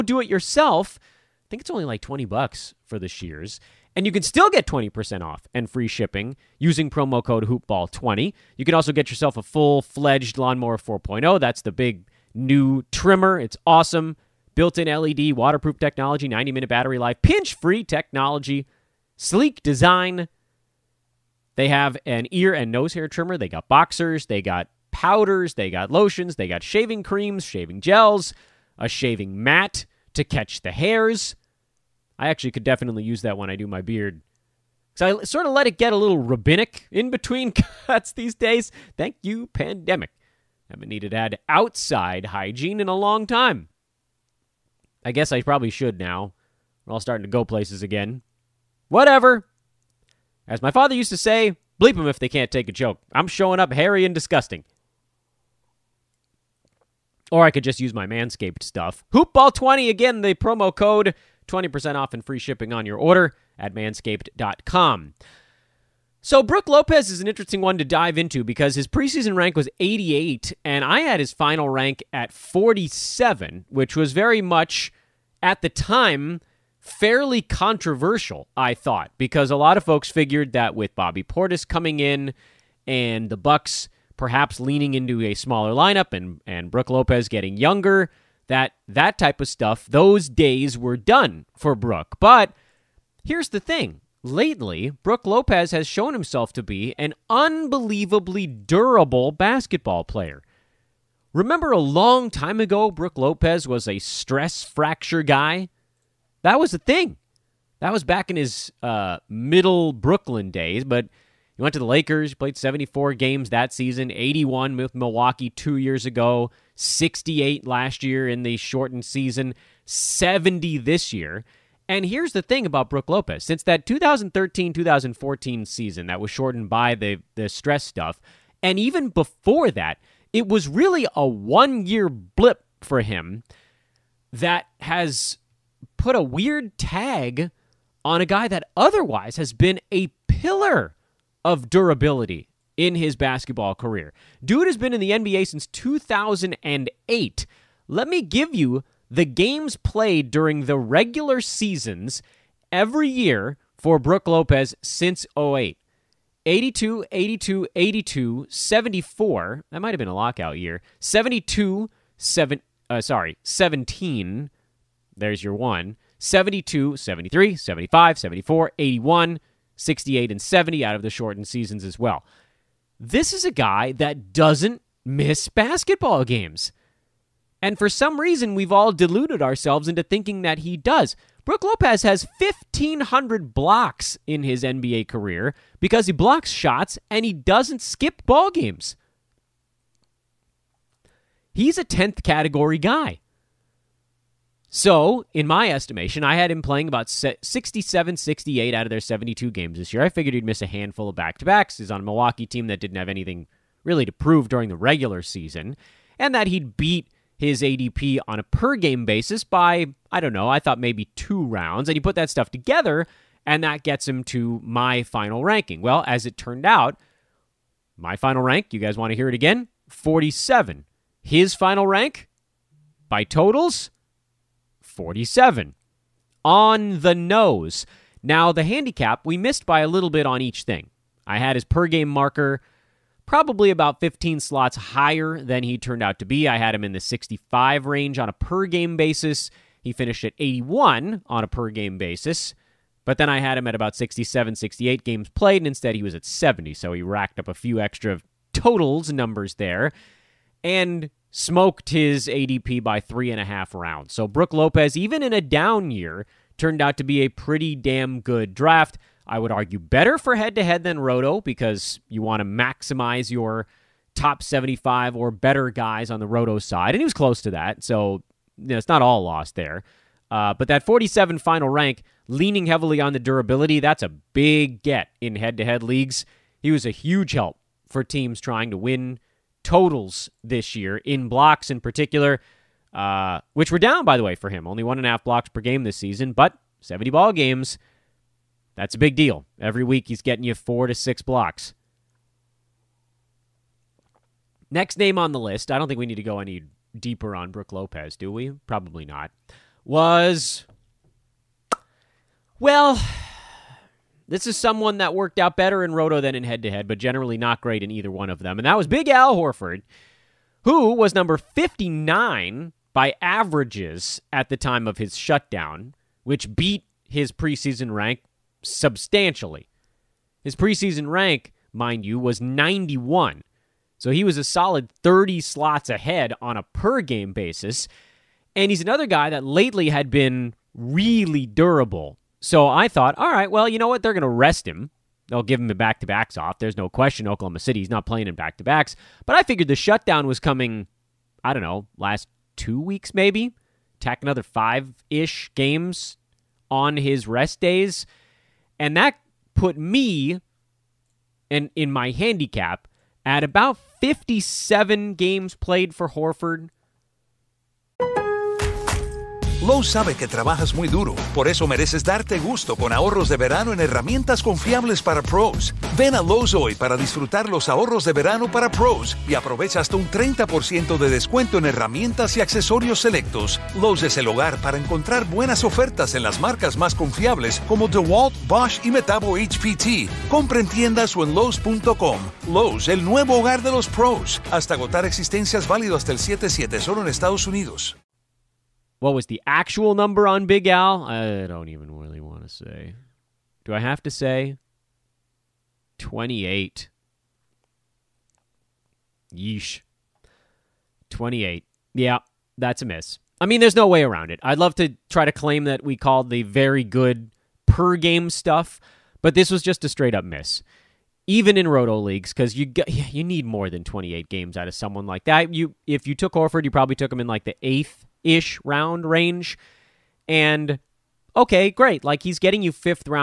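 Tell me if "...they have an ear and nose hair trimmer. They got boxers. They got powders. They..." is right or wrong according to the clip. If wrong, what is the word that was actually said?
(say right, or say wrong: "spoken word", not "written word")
right.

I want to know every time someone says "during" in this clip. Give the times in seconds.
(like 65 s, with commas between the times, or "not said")
150 s, 204 s.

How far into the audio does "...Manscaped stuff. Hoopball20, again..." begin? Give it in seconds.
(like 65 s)
58 s.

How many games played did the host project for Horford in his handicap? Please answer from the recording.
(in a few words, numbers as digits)
57.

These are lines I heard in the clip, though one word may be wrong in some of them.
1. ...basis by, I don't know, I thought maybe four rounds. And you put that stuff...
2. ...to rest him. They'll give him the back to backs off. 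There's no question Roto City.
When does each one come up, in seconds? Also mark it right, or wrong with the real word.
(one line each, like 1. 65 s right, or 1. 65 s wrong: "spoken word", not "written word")
1. 209 s wrong: "two", not "four"
2. 334 s wrong: "Oklahoma", not "Roto".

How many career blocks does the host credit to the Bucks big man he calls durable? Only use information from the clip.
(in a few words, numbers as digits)
1,500.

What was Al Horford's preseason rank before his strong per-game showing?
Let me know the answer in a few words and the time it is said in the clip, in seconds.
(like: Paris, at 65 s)
91, at 322 s.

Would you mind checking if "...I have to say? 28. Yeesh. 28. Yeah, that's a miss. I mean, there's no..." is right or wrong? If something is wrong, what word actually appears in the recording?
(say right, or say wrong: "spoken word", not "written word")
right.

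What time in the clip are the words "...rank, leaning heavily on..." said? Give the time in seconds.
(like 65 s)
271 s.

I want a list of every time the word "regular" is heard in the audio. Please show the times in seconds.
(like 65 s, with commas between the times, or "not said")
150 s, 204 s.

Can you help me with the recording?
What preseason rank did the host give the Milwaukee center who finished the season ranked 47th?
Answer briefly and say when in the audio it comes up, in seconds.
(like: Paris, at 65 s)
88, at 69 s.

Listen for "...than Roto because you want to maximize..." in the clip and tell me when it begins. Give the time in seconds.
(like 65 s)
260 s.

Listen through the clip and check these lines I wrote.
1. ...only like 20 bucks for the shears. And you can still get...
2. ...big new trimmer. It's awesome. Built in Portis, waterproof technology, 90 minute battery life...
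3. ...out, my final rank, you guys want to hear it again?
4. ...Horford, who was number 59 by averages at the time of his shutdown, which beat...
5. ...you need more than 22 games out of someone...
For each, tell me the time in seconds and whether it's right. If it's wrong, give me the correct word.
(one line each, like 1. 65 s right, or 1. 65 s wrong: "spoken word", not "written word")
1. 1 s right
2. 11 s wrong: "LED", not "Portis"
3. 216 s right
4. 309 s right
5. 412 s wrong: "28", not "22".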